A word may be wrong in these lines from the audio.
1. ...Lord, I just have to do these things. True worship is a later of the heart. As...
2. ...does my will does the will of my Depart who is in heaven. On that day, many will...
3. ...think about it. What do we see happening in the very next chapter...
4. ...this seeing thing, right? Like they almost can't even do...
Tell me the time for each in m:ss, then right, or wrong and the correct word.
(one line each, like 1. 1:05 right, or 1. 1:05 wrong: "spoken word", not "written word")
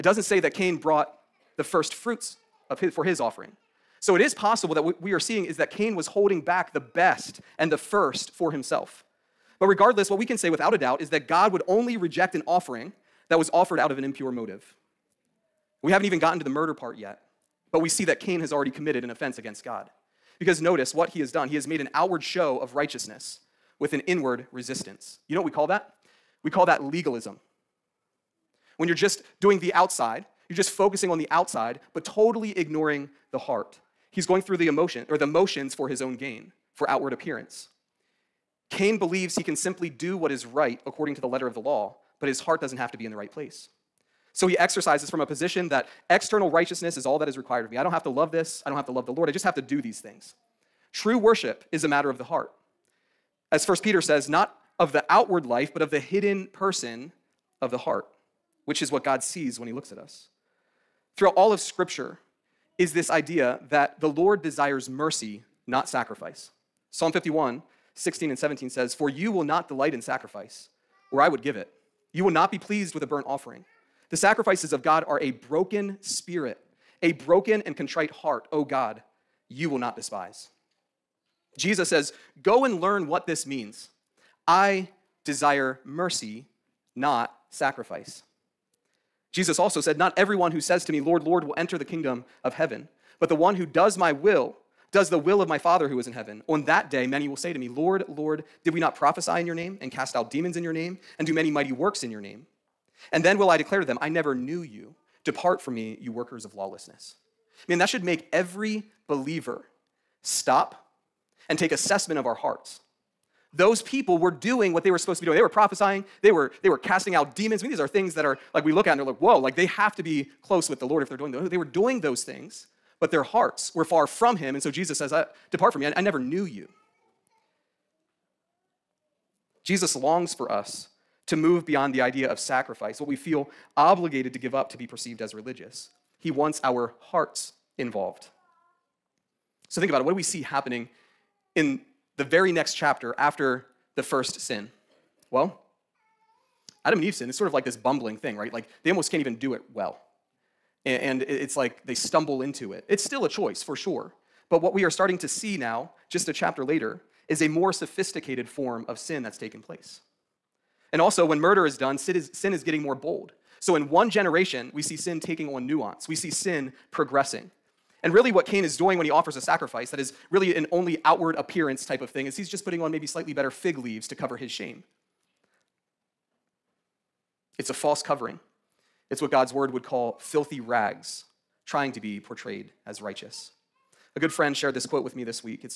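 1. 0:49 wrong: "matter", not "later"
2. 1:33 wrong: "Father", not "Depart"
3. 2:19 right
4. 2:27 wrong: "bumbling", not "seeing".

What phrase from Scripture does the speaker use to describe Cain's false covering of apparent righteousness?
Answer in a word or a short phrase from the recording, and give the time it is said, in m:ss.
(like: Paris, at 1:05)
Filthy rags, at 3:00.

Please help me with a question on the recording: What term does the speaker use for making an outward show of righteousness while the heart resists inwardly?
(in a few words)
Legalism.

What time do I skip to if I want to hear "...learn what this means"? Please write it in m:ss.
1:22.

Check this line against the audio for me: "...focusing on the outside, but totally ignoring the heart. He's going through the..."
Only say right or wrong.
right.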